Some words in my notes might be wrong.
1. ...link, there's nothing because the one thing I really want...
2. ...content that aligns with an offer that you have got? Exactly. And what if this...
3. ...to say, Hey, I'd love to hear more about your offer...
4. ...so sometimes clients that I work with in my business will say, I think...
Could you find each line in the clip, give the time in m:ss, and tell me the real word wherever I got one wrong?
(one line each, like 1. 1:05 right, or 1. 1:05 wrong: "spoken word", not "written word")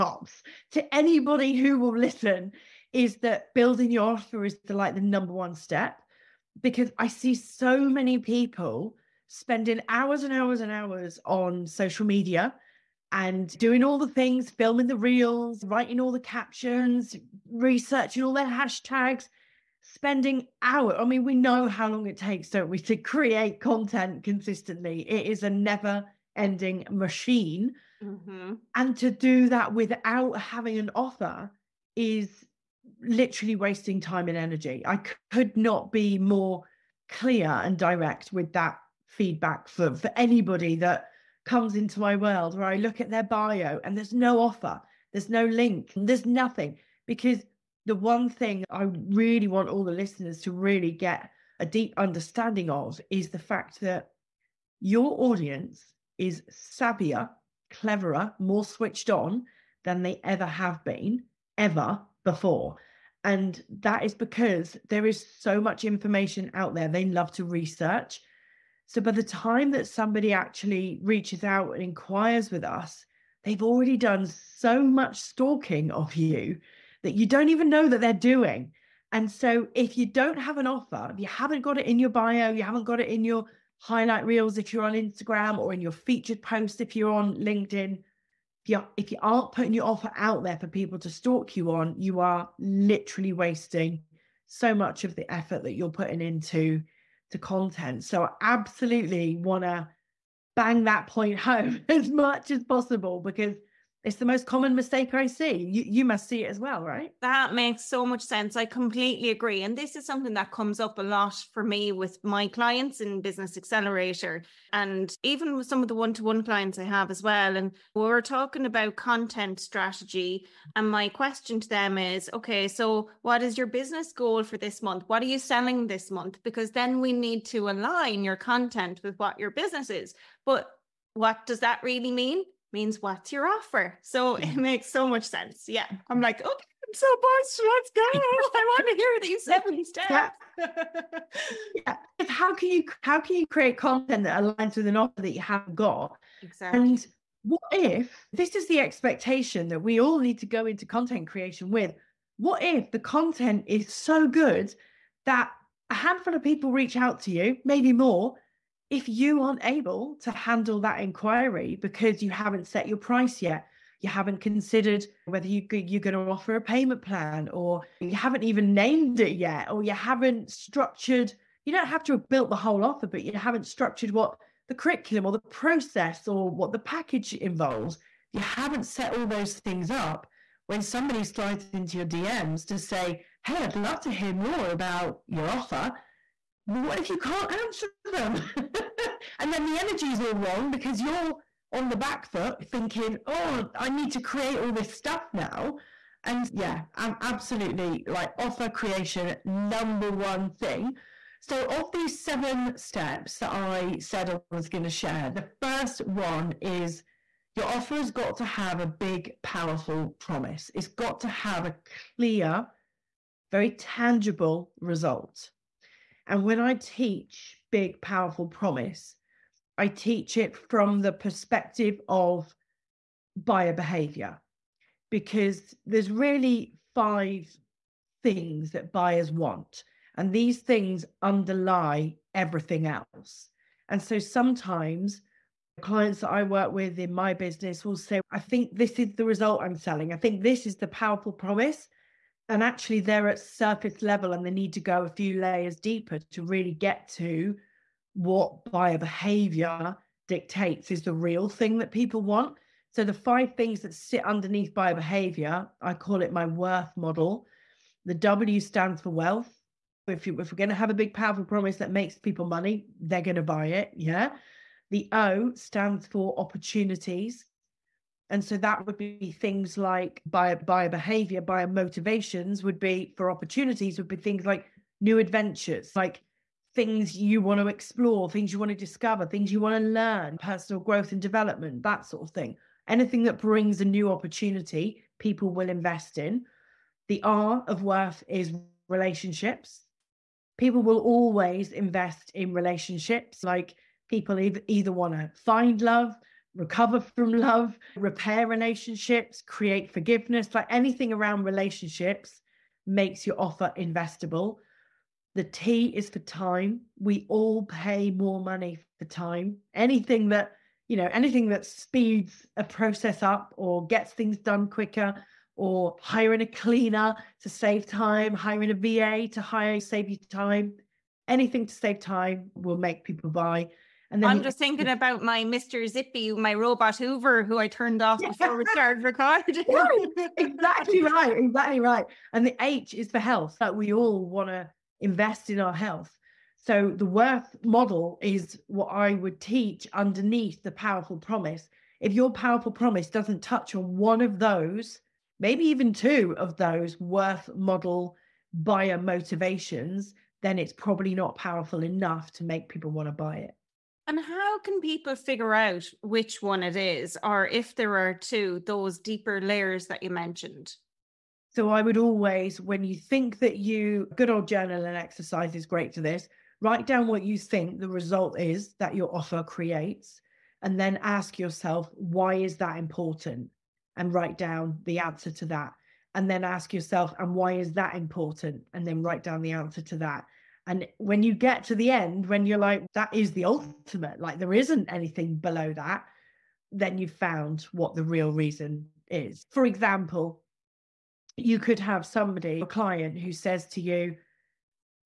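1. 0:45 right
2. 2:23 right
3. 3:02 right
4. 3:54 right.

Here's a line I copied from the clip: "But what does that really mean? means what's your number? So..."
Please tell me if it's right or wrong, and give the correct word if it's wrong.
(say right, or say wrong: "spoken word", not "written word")
wrong: "offer", not "number".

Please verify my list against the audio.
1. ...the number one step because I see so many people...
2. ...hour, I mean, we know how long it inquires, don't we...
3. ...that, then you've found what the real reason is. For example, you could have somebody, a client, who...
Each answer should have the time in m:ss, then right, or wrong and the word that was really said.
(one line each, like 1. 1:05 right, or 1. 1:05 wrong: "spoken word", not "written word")
1. 0:04 right
2. 0:20 wrong: "takes", not "inquires"
3. 6:25 right.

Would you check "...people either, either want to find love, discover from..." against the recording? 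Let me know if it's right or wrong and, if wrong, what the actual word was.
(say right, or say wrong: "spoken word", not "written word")
wrong: "recover", not "discover".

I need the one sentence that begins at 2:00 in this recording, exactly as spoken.
And my question to them is okay, so what is your business goal for this month?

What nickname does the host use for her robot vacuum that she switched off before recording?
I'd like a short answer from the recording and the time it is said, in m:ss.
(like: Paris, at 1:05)
Mr. Zippy, at 5:25.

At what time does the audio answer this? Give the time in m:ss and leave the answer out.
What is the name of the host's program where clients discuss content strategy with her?
1:53.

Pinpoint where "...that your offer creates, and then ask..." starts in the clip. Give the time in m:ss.
6:08.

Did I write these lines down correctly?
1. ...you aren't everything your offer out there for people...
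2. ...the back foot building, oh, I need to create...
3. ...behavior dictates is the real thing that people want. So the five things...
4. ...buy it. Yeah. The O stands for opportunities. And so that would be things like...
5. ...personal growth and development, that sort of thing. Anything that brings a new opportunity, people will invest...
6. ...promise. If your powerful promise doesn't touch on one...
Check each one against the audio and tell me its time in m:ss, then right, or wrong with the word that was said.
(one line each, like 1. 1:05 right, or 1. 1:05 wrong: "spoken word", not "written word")
1. 1:29 wrong: "putting", not "everything"
2. 3:11 wrong: "thinking", not "building"
3. 4:08 right
4. 4:23 right
5. 4:40 right
6. 5:41 right.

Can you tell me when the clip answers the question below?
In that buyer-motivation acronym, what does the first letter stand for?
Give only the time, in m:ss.
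4:19.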